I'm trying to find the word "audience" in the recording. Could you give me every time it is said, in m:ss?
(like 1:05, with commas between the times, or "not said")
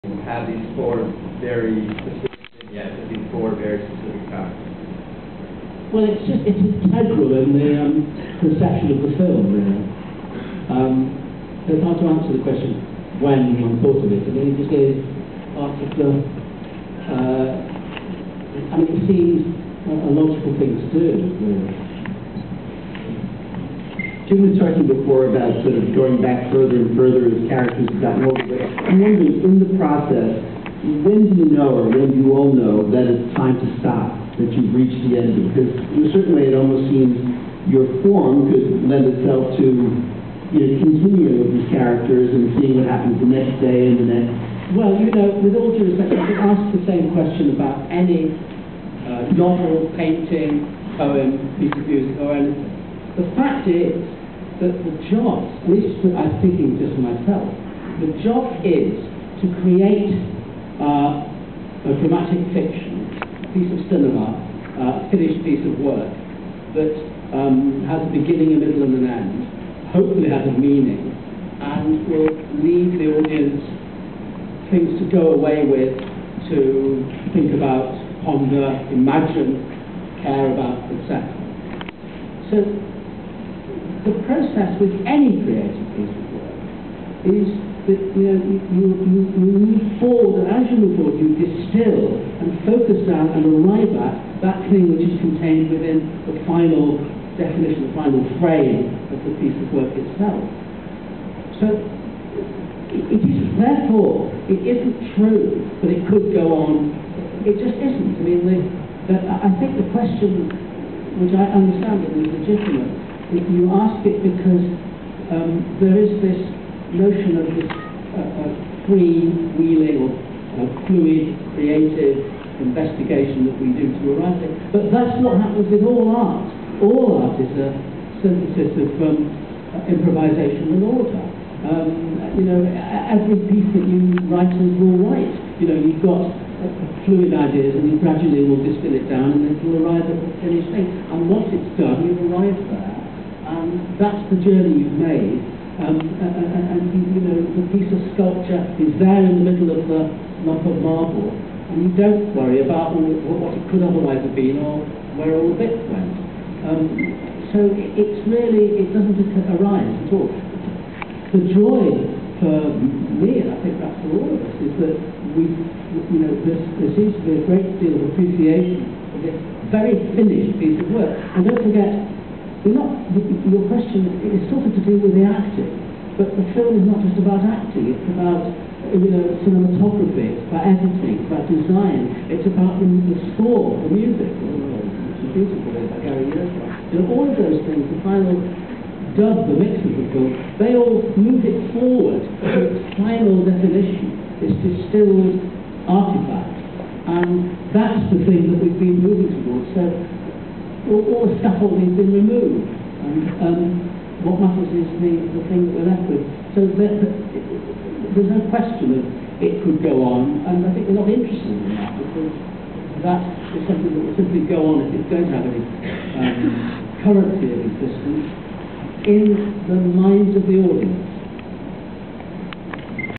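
1:13, 3:40.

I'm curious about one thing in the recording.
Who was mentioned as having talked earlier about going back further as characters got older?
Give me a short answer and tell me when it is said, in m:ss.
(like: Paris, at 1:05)
Tim, at 0:24.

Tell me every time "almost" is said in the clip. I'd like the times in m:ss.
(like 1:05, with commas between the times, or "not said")
0:36.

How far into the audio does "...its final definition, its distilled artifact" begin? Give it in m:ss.
3:12.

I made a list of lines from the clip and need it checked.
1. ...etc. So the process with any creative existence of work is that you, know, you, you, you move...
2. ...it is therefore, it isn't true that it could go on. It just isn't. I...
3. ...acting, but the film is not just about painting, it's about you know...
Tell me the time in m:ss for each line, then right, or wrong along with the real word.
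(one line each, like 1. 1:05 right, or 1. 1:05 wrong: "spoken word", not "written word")
1. 1:20 wrong: "piece", not "existence"
2. 1:43 right
3. 2:55 wrong: "acting", not "painting".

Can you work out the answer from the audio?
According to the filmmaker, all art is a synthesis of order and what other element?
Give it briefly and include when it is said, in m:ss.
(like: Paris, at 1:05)
Improvisation, at 2:09.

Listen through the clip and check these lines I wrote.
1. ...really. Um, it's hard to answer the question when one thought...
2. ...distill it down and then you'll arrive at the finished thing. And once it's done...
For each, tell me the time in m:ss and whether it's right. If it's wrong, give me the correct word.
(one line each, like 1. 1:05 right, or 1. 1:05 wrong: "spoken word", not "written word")
1. 0:09 right
2. 2:18 right.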